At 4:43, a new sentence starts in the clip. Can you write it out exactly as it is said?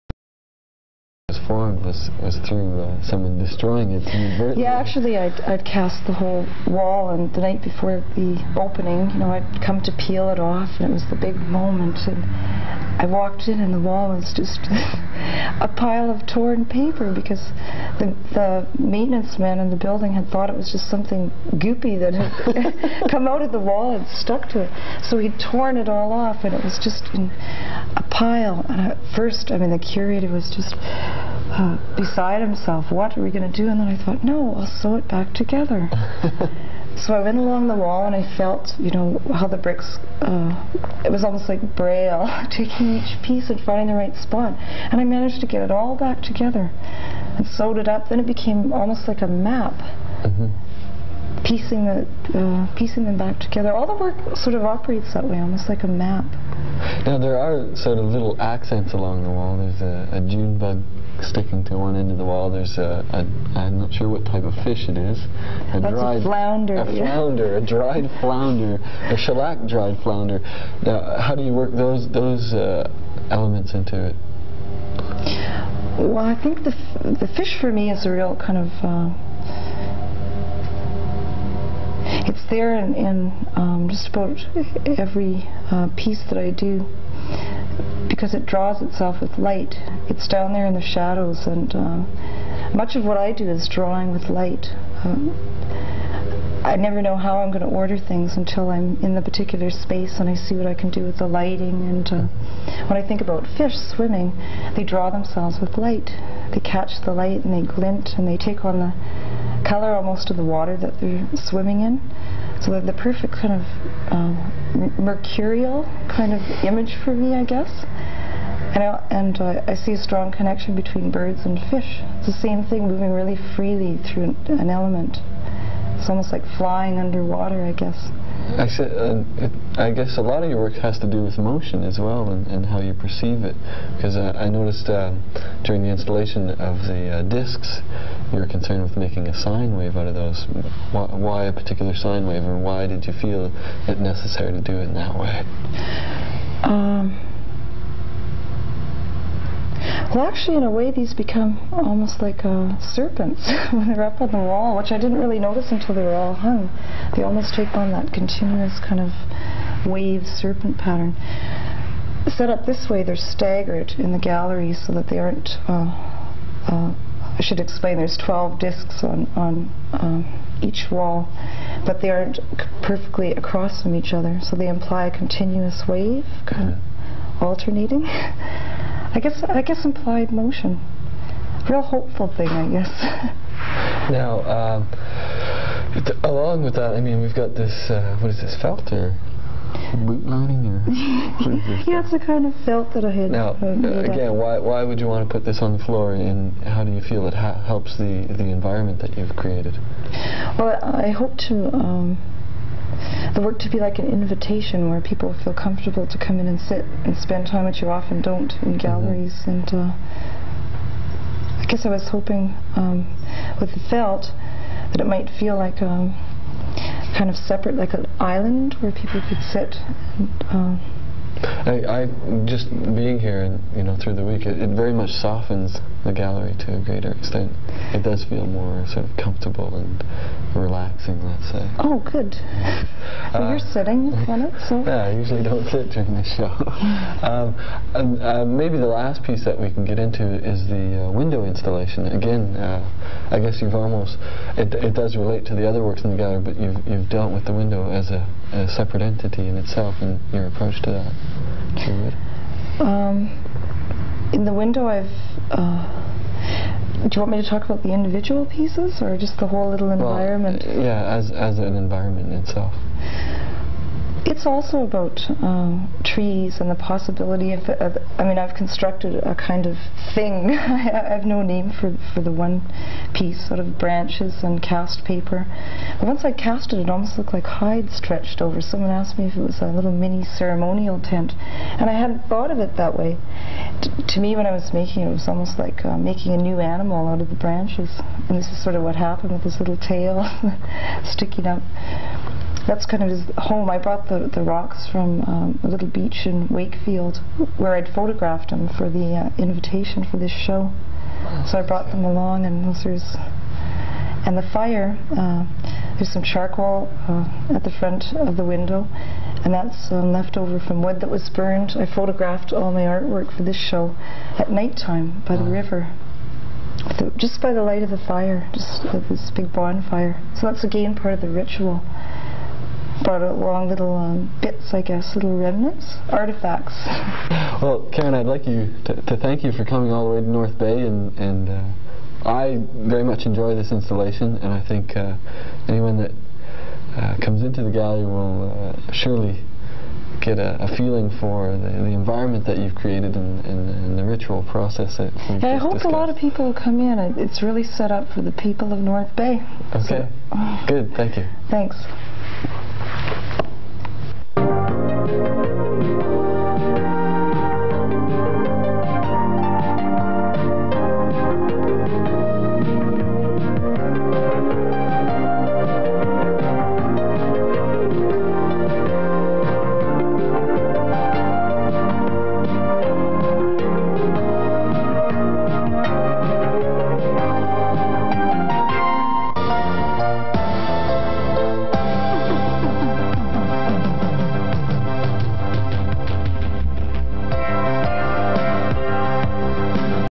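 T to me, when I was making it, it was almost like uh, making a new animal out of the branches.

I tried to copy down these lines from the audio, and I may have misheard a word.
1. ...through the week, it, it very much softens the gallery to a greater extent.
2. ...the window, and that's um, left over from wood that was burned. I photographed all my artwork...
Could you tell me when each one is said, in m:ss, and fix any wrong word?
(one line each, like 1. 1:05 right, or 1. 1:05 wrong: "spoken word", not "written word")
1. 3:43 right
2. 5:08 right.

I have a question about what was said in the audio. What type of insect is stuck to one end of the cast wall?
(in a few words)
June bug.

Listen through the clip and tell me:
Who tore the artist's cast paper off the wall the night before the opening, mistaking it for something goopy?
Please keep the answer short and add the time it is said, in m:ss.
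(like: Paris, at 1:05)
The maintenance man, at 0:18.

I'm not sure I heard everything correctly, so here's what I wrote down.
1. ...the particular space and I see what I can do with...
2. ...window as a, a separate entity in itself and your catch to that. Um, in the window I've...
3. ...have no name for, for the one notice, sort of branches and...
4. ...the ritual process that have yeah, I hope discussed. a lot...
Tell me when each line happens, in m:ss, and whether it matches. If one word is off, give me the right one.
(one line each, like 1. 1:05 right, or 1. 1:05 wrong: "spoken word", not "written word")
1. 1:39 right
2. 4:07 wrong: "approach", not "catch"
3. 4:31 wrong: "piece", not "notice"
4. 5:43 right.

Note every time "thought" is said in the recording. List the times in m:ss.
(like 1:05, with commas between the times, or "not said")
0:20, 0:34, 4:42.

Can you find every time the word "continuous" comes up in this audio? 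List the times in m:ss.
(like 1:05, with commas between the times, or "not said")
2:38, 2:55.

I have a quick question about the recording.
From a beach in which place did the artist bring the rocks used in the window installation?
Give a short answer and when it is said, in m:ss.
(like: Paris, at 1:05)
Wakefield, at 4:56.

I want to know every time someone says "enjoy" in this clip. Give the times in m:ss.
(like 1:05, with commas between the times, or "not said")
5:33.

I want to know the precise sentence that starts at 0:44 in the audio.
And I managed to get it all back together and sewed it up.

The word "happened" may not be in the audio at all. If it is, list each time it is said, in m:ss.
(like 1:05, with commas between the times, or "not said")
4:48.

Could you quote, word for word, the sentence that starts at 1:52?
So the perfect kind of uh, mercurial kind of image for me, I guess.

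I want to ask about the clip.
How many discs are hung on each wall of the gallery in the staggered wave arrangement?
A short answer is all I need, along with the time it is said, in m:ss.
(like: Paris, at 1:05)
12, at 2:48.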